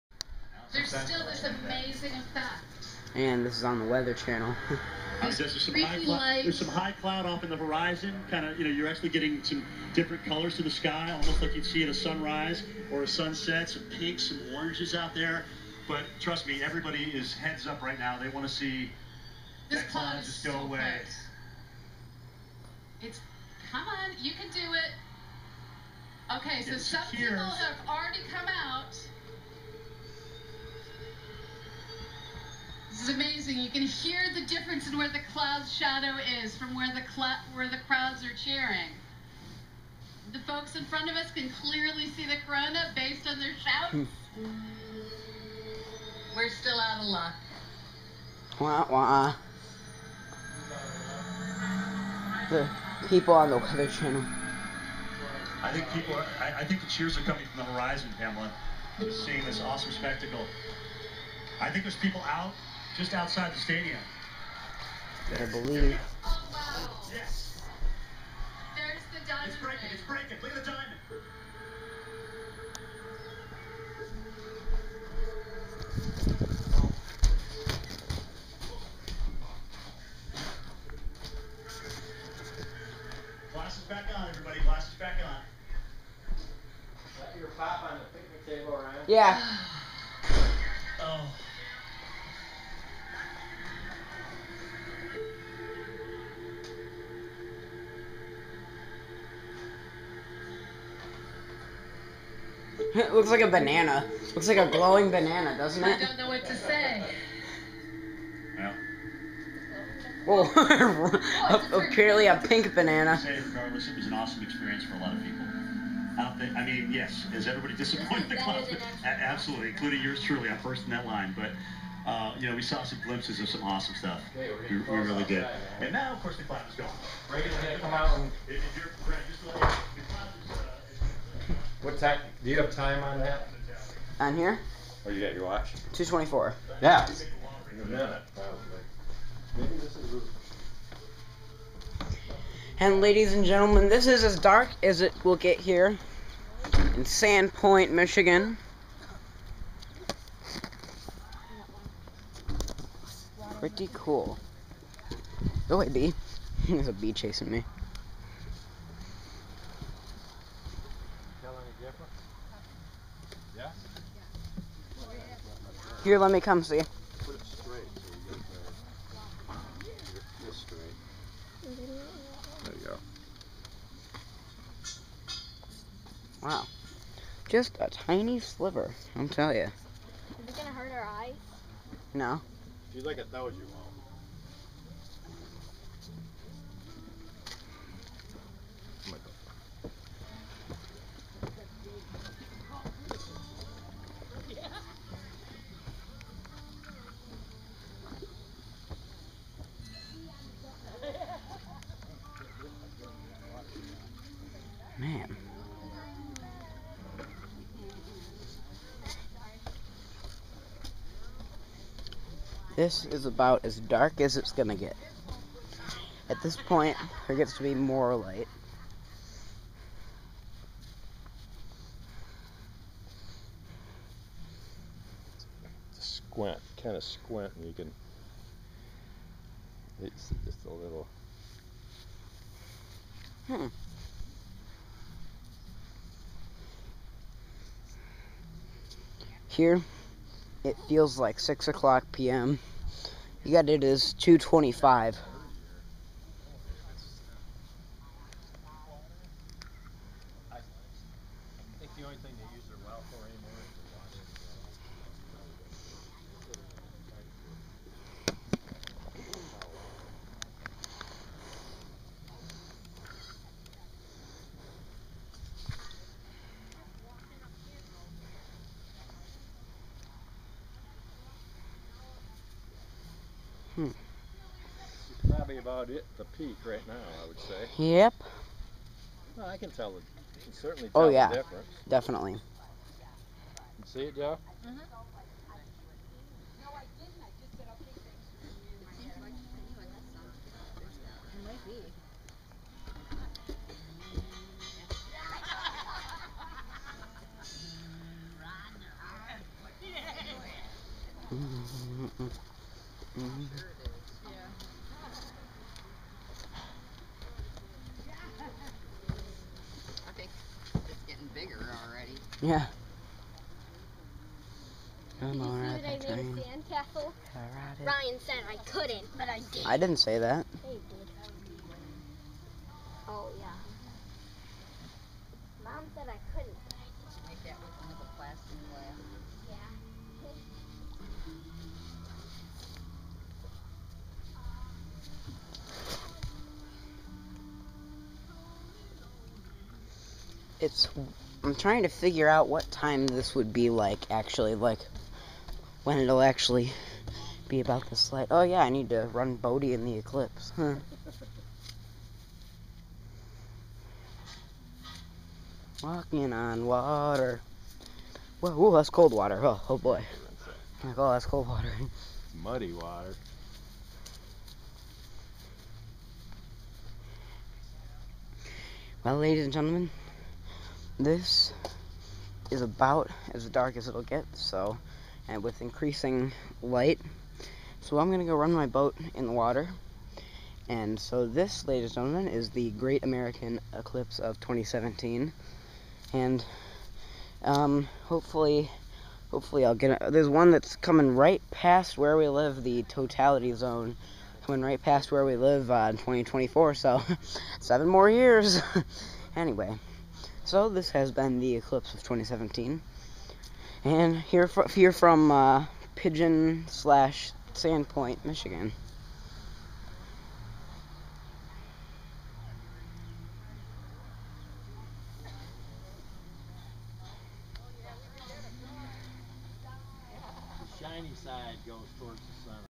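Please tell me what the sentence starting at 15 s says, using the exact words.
But trust me, everybody is heads up right now.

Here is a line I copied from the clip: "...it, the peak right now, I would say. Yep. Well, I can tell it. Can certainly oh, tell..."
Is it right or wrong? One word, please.
right.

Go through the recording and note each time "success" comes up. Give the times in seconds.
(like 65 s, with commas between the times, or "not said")
not said.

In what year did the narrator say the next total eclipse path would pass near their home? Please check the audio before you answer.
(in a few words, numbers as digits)
2024.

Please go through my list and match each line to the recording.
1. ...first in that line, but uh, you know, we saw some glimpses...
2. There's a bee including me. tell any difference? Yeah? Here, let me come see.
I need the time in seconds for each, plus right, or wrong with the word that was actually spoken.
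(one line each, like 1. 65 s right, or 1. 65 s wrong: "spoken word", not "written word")
1. 120 s right
2. 156 s wrong: "chasing", not "including".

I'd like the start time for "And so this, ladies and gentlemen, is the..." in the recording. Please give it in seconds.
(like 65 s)
380 s.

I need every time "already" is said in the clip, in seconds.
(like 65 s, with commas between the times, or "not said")
27 s, 311 s.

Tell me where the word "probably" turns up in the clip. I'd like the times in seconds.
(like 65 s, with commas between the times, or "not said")
138 s, 275 s.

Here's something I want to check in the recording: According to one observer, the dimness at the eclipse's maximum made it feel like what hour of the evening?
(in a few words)
6 p.m.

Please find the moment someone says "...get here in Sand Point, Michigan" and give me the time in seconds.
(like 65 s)
145 s.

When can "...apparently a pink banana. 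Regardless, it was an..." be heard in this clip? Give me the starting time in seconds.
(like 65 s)
111 s.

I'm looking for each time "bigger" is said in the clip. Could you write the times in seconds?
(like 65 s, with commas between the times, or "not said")
311 s.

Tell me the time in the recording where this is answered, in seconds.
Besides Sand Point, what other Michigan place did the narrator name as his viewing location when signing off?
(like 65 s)
405 s.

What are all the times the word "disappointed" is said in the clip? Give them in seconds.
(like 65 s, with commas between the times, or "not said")
117 s.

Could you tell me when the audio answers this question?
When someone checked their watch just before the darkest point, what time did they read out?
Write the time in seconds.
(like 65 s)
135 s.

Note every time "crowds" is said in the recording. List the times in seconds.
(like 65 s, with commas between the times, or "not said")
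37 s.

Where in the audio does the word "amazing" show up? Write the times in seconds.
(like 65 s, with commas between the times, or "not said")
1 s, 33 s.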